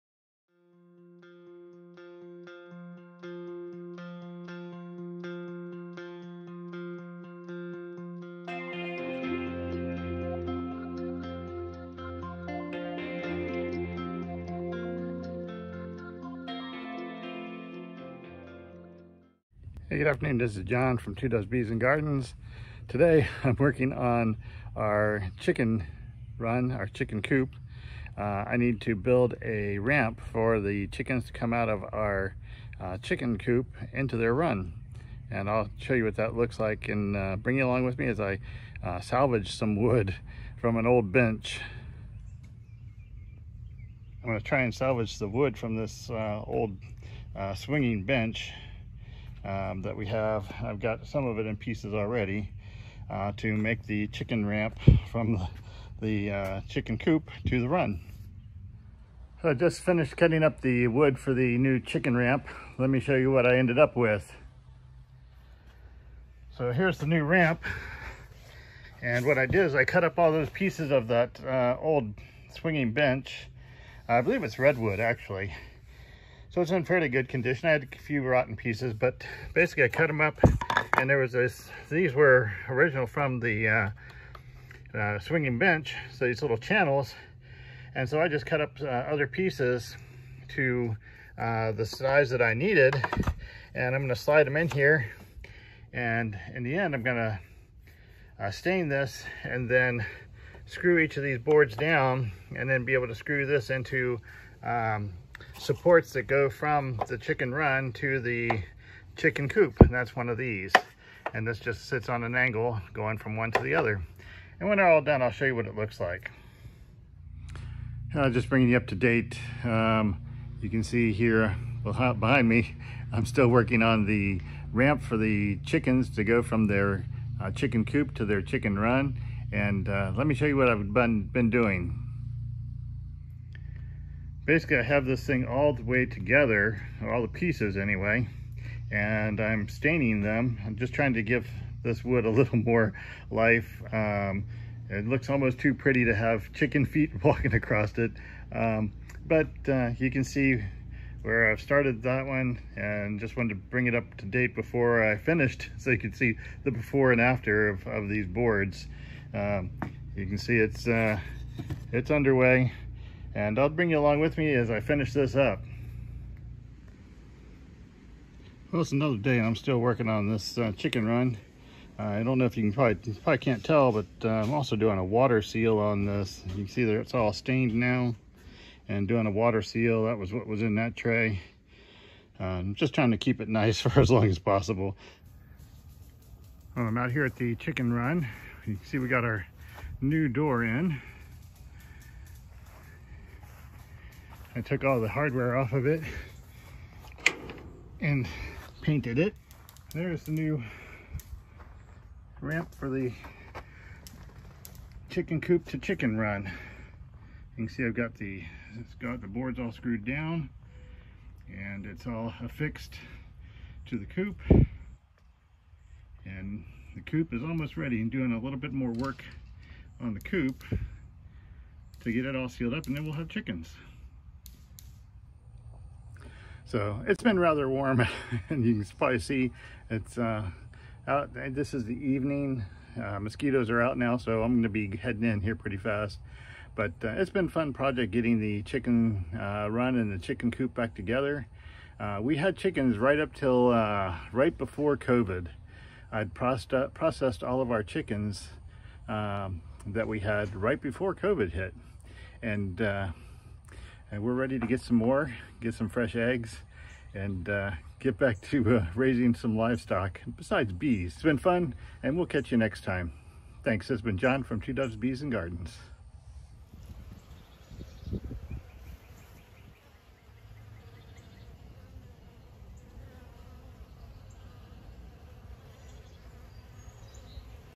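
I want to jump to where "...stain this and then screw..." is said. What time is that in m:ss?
1:38.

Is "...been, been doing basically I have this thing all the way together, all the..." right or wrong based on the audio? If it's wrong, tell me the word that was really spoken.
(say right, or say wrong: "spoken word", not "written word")
right.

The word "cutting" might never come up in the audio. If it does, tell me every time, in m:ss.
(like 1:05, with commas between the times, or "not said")
1:00.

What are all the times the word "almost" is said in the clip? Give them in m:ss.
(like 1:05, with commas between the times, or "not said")
2:25, 3:37.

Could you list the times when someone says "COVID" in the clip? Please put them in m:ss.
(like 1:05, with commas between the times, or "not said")
4:04, 4:11.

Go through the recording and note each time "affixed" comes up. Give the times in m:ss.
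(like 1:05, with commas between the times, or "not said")
3:32.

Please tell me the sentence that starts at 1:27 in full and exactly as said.
And so I just cut up uh, other pieces to uh, the size that I needed.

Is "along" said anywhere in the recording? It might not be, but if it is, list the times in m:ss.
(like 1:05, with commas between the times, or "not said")
0:37, 2:43.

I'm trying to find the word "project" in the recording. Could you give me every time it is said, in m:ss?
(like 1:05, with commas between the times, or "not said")
3:57.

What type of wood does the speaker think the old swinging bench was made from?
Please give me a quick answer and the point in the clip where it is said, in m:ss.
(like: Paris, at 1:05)
Redwood, at 1:14.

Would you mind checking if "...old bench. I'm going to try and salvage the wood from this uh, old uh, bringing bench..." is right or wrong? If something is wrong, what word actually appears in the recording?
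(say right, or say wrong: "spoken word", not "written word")
wrong: "swinging", not "bringing".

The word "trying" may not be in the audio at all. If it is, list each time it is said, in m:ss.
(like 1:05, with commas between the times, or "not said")
2:20, 3:02.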